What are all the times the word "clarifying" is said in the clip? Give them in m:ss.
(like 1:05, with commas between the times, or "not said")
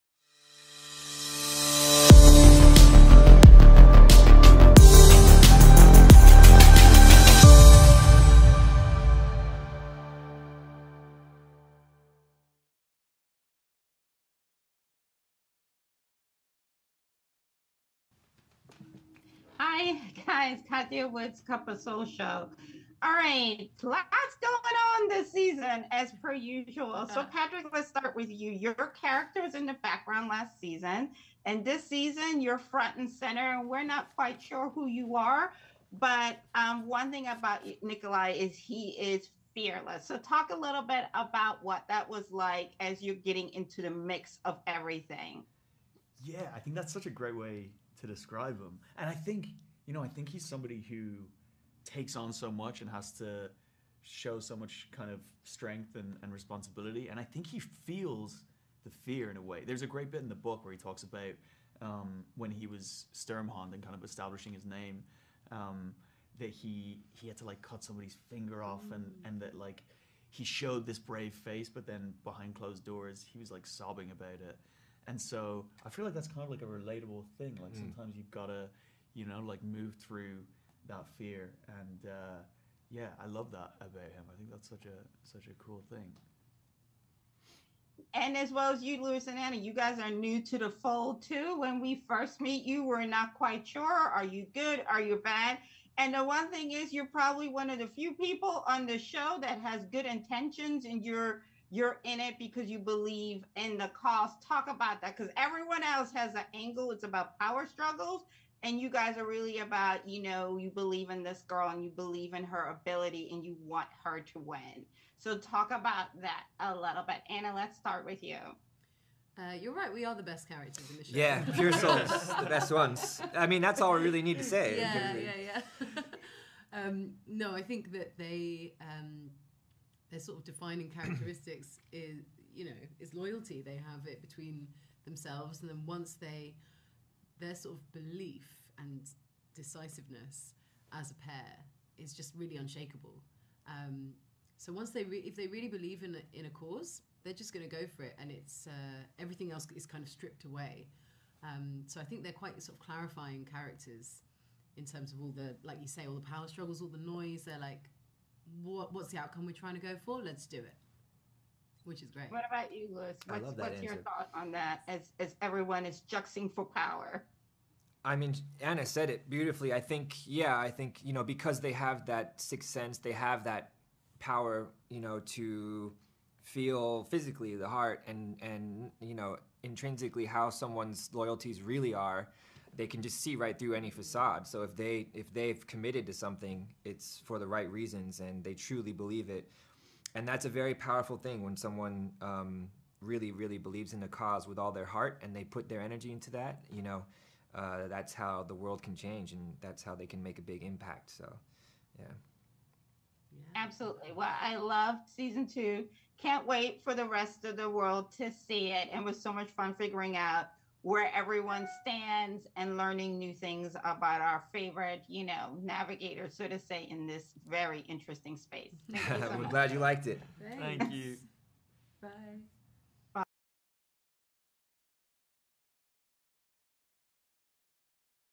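2:32.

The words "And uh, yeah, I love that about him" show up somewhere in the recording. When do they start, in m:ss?
1:21.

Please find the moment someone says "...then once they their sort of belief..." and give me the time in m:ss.
2:15.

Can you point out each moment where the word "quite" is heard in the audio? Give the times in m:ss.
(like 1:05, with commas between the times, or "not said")
0:34, 1:33, 2:32.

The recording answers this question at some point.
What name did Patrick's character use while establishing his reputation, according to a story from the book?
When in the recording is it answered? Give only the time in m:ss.
1:03.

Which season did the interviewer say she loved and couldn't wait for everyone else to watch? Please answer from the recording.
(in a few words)
Season two.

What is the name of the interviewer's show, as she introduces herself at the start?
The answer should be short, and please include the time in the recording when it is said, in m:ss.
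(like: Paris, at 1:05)
Cup of Soul Show, at 0:21.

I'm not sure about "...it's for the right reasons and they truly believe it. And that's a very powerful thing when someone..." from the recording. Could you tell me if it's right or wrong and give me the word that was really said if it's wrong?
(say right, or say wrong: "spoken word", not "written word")
right.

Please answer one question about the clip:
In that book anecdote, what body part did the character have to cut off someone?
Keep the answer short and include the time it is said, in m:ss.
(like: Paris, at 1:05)
Finger, at 1:08.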